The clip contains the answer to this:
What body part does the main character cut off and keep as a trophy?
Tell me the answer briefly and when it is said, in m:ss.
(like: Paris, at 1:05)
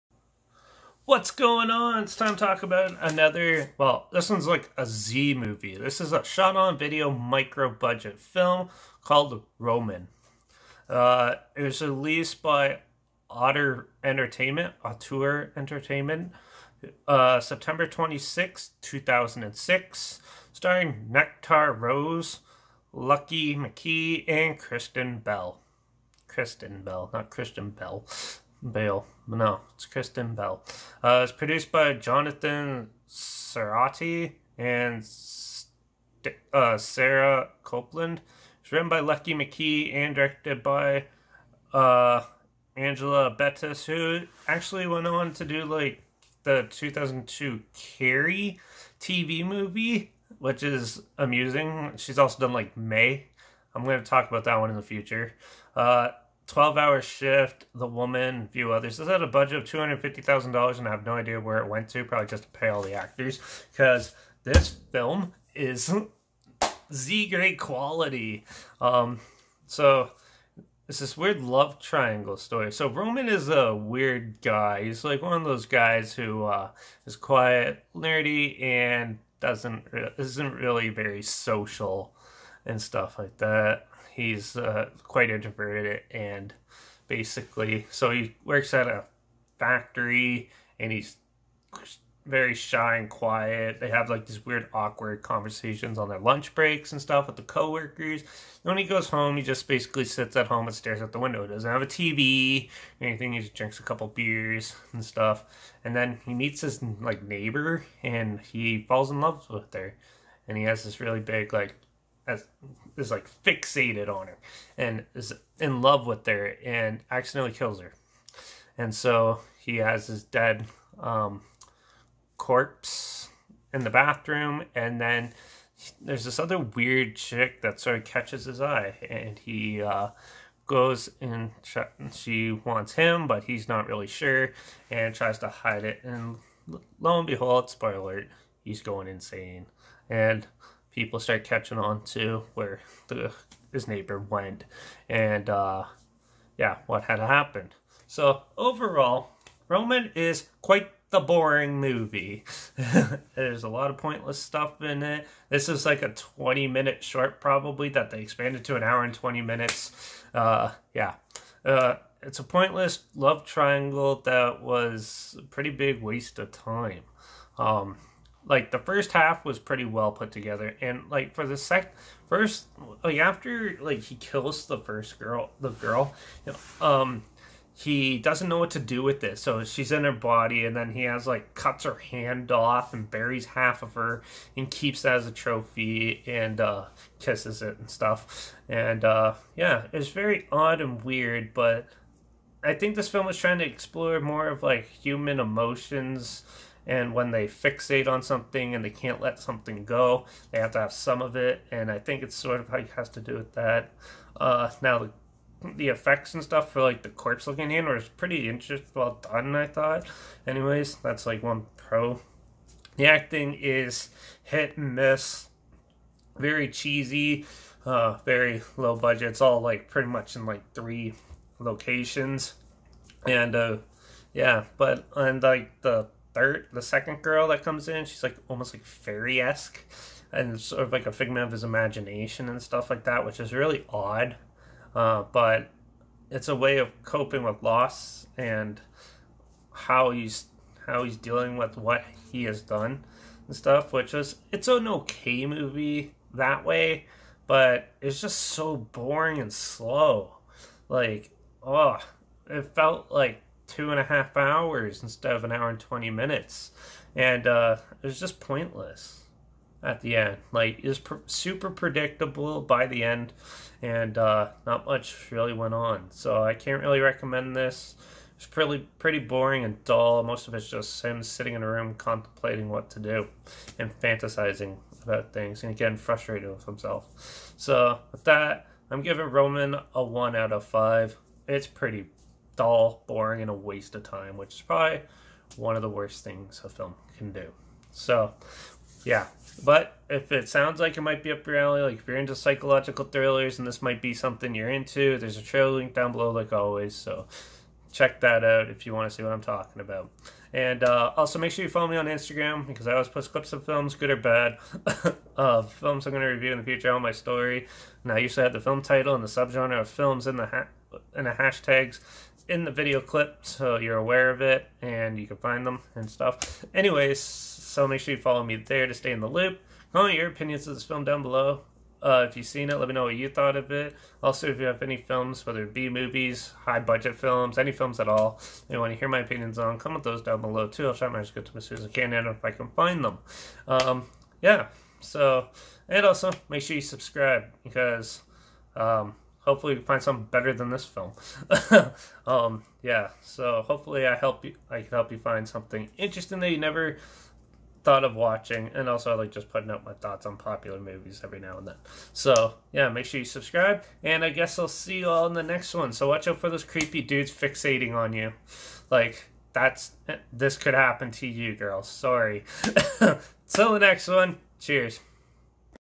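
her hand, at 3:01.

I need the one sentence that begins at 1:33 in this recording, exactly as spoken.
They have like these weird, awkward conversations on their lunch breaks and stuff with the coworkers.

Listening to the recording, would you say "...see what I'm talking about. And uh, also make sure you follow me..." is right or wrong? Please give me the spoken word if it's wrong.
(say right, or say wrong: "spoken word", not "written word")
right.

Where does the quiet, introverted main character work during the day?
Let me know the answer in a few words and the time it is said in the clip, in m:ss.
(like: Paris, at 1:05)
a factory, at 1:28.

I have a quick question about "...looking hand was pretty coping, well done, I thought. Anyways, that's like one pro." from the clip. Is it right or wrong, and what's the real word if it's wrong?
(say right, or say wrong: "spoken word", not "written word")
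wrong: "interesting", not "coping".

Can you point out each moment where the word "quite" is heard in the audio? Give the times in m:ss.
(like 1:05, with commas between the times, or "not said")
1:25, 2:30.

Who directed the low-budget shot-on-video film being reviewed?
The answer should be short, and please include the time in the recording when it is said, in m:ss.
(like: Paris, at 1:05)
Angela Bettis, at 0:42.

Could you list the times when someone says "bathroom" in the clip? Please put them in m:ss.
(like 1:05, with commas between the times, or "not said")
2:03.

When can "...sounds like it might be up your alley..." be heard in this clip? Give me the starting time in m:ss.
4:50.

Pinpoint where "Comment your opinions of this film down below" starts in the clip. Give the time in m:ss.
5:19.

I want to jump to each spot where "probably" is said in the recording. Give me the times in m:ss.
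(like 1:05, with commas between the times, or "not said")
1:02, 2:37, 4:44.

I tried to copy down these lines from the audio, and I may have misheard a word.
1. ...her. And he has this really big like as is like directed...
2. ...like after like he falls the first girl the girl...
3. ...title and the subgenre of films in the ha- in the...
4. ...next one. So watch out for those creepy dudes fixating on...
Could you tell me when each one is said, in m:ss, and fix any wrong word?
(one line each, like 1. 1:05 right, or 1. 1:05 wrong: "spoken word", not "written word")
1. 1:49 wrong: "fixated", not "directed"
2. 2:53 wrong: "kills", not "falls"
3. 5:08 right
4. 5:55 right.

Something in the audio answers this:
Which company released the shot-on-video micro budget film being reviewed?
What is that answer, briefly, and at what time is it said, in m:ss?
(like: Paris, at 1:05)
Auteur Entertainment, at 0:14.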